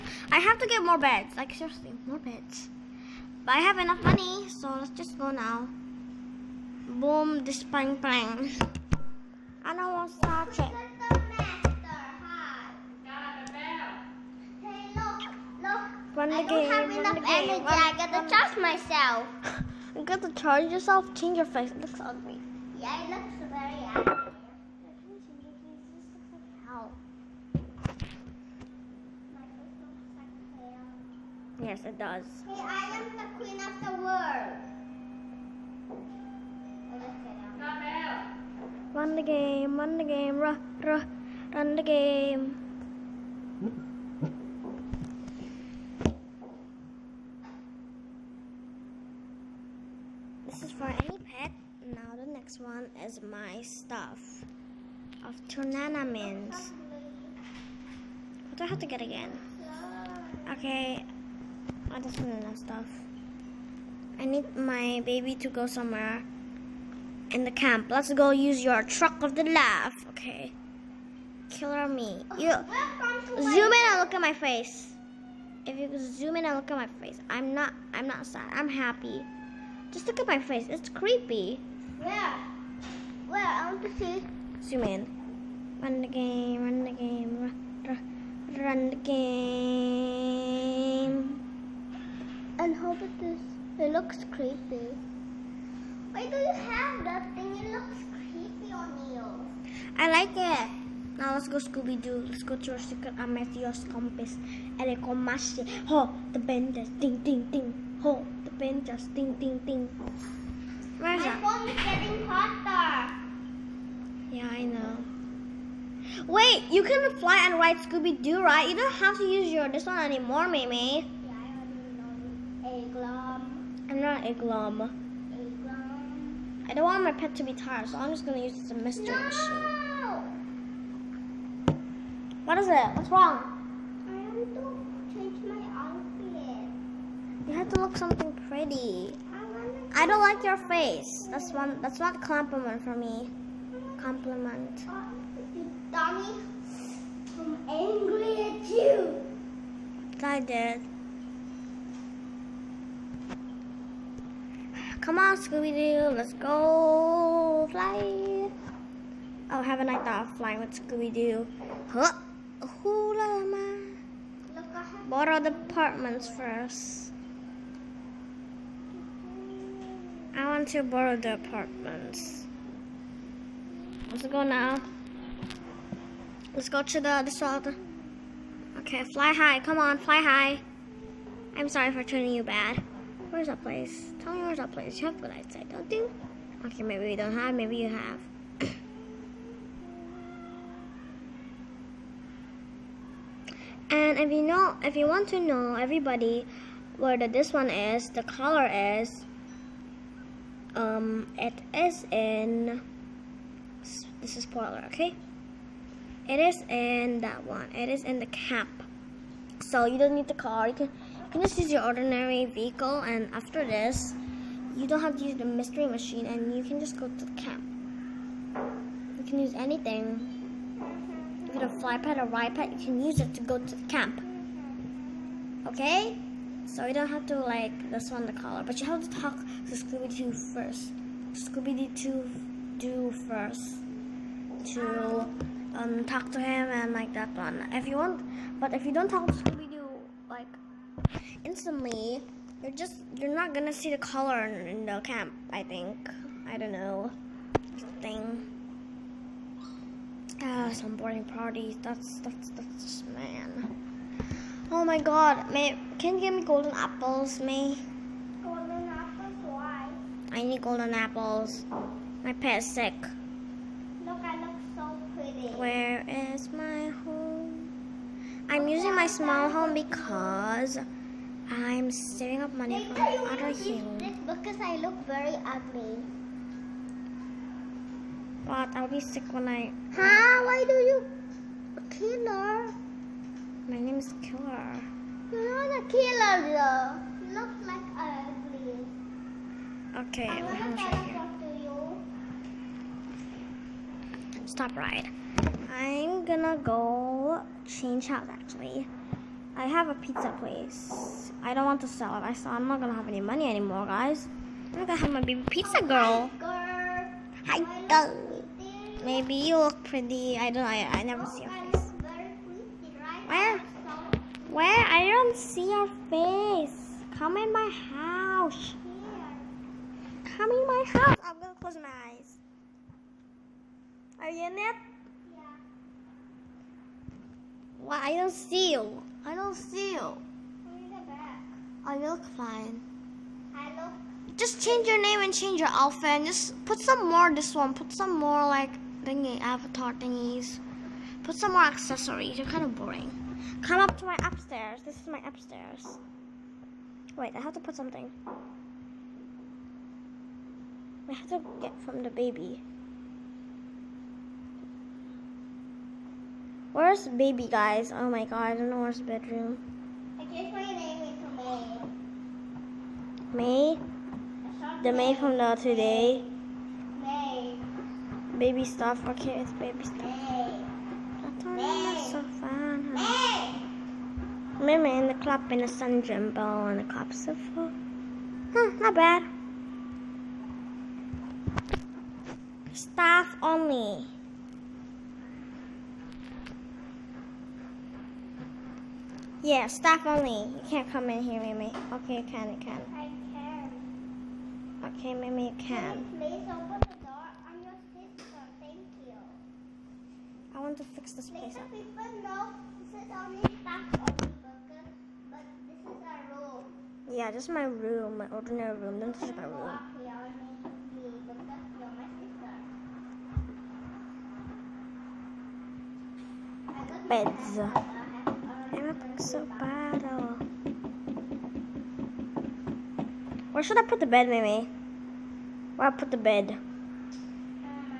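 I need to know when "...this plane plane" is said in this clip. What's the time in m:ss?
0:07.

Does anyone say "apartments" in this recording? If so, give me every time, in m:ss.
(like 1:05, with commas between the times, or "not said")
2:45, 2:51.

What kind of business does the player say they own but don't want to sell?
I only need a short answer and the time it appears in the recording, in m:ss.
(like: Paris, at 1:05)
Pizza place, at 4:59.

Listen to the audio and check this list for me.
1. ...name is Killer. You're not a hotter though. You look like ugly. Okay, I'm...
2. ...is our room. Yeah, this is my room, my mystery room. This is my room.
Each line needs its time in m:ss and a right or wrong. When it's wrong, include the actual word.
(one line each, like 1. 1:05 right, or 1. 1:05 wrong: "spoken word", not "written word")
1. 4:43 wrong: "killer", not "hotter"
2. 6:45 wrong: "ordinary", not "mystery".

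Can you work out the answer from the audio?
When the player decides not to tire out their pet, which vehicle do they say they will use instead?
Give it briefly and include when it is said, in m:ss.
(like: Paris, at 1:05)
Mystery Machine, at 2:08.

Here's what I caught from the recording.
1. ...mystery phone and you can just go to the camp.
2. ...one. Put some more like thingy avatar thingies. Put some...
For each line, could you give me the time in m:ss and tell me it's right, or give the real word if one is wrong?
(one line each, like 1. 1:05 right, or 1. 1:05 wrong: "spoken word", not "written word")
1. 3:35 wrong: "machine", not "phone"
2. 5:37 right.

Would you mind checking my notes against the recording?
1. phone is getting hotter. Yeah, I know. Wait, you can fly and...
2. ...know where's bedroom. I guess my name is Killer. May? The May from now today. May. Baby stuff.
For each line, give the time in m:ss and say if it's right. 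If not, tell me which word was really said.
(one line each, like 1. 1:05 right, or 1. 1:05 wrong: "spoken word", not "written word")
1. 1:51 right
2. 5:58 wrong: "May", not "Killer".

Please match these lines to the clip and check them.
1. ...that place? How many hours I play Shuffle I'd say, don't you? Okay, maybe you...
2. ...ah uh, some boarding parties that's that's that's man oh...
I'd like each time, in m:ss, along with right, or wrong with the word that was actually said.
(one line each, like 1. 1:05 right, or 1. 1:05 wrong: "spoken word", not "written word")
1. 3:03 right
2. 4:10 right.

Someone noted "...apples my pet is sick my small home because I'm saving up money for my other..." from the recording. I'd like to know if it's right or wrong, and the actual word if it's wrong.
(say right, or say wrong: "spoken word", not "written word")
right.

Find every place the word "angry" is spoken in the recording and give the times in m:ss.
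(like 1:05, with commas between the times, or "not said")
2:27.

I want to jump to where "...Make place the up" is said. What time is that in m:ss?
6:41.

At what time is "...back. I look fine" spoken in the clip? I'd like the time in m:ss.
5:31.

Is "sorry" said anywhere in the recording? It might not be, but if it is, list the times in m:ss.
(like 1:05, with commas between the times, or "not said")
3:01.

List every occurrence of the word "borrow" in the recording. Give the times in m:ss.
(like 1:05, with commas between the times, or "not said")
2:45, 2:50.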